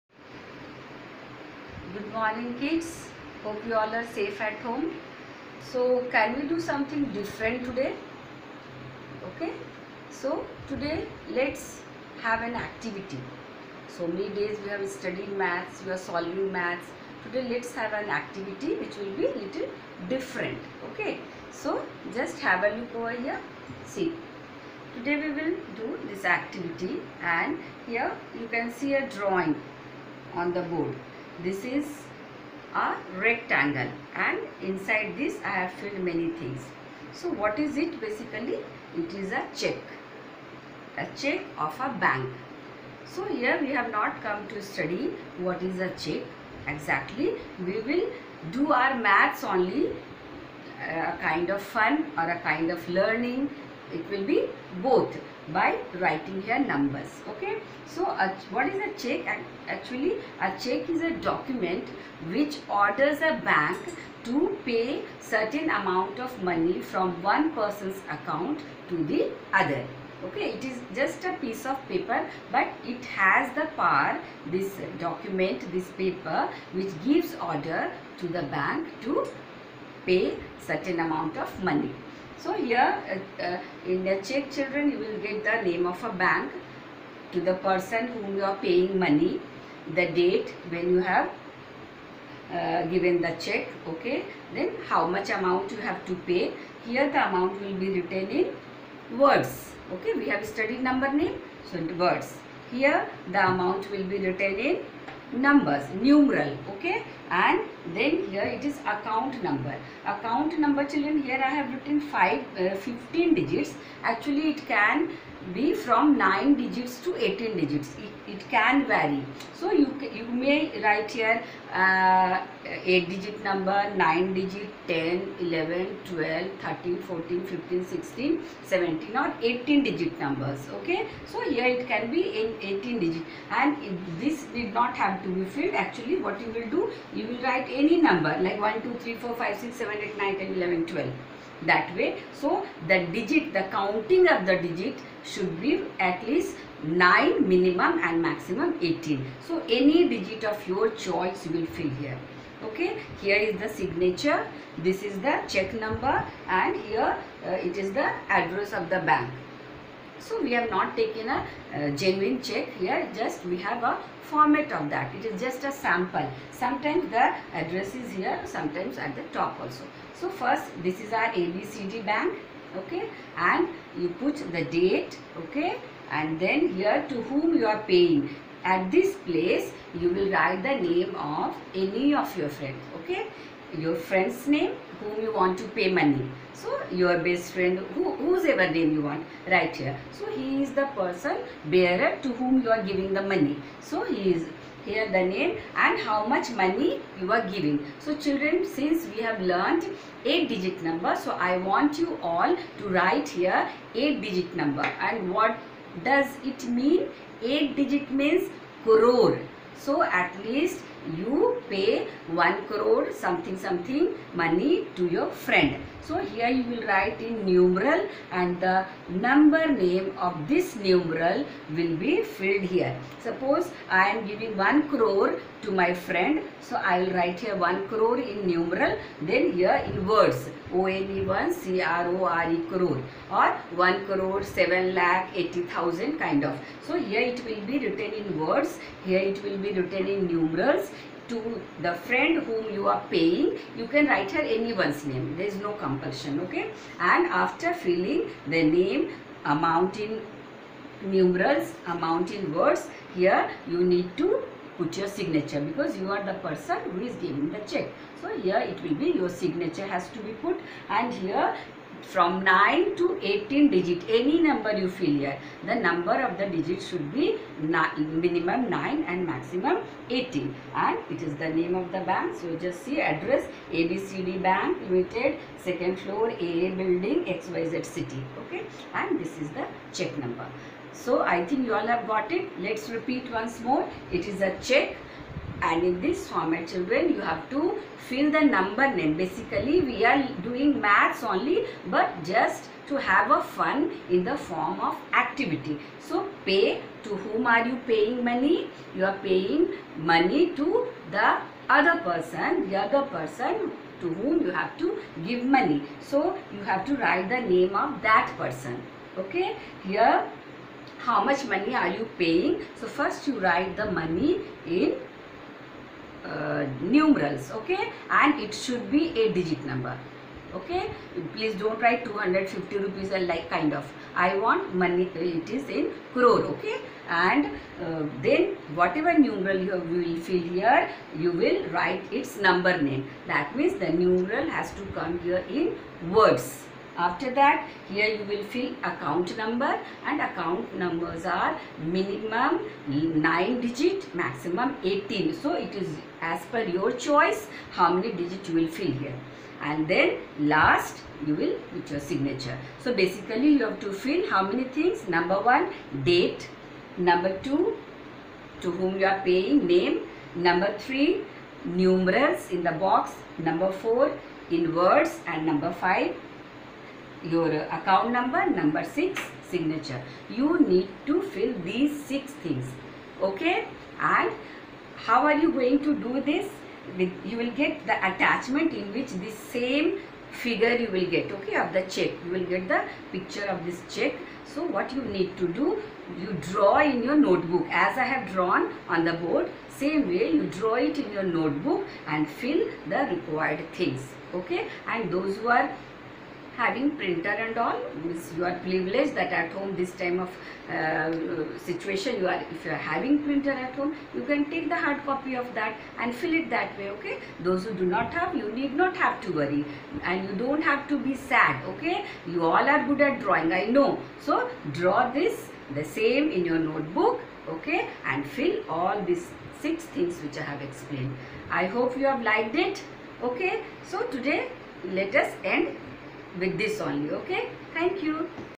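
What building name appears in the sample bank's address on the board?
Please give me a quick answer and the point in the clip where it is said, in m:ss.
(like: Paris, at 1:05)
AA building, at 4:36.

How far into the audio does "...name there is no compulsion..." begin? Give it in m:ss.
4:05.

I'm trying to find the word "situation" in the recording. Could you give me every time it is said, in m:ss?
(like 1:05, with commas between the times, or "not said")
6:41.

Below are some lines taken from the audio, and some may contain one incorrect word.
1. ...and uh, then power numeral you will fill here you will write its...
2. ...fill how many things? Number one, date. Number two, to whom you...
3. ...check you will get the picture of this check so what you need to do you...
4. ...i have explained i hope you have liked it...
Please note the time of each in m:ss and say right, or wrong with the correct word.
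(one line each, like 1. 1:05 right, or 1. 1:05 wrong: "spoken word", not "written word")
1. 5:27 wrong: "whatever", not "power"
2. 5:53 right
3. 6:21 right
4. 7:00 right.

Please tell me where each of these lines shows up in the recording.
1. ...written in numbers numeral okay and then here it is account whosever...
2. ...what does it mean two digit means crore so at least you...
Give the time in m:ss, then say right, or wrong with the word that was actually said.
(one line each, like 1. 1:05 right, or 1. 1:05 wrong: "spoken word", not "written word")
1. 1:44 wrong: "number", not "whosever"
2. 3:25 wrong: "eight", not "two".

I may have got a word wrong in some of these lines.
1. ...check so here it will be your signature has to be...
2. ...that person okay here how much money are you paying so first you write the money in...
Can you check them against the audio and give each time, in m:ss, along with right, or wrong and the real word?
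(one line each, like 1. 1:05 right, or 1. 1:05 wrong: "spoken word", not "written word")
1. 4:17 right
2. 5:08 right.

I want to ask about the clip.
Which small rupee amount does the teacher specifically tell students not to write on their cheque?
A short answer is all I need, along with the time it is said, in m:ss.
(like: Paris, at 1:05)
250 rupees, at 5:22.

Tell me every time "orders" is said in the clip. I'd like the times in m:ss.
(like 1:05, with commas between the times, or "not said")
1:02, 1:17.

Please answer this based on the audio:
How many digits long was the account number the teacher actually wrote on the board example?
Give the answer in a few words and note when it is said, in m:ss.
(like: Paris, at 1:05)
15, at 1:52.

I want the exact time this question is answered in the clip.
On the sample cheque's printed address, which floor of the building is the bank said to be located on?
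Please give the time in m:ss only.
4:35.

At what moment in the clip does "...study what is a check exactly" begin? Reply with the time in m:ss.
0:44.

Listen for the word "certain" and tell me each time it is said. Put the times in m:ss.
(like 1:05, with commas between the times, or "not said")
1:05, 1:20.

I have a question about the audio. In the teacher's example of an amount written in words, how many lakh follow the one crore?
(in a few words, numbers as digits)
7 lakh.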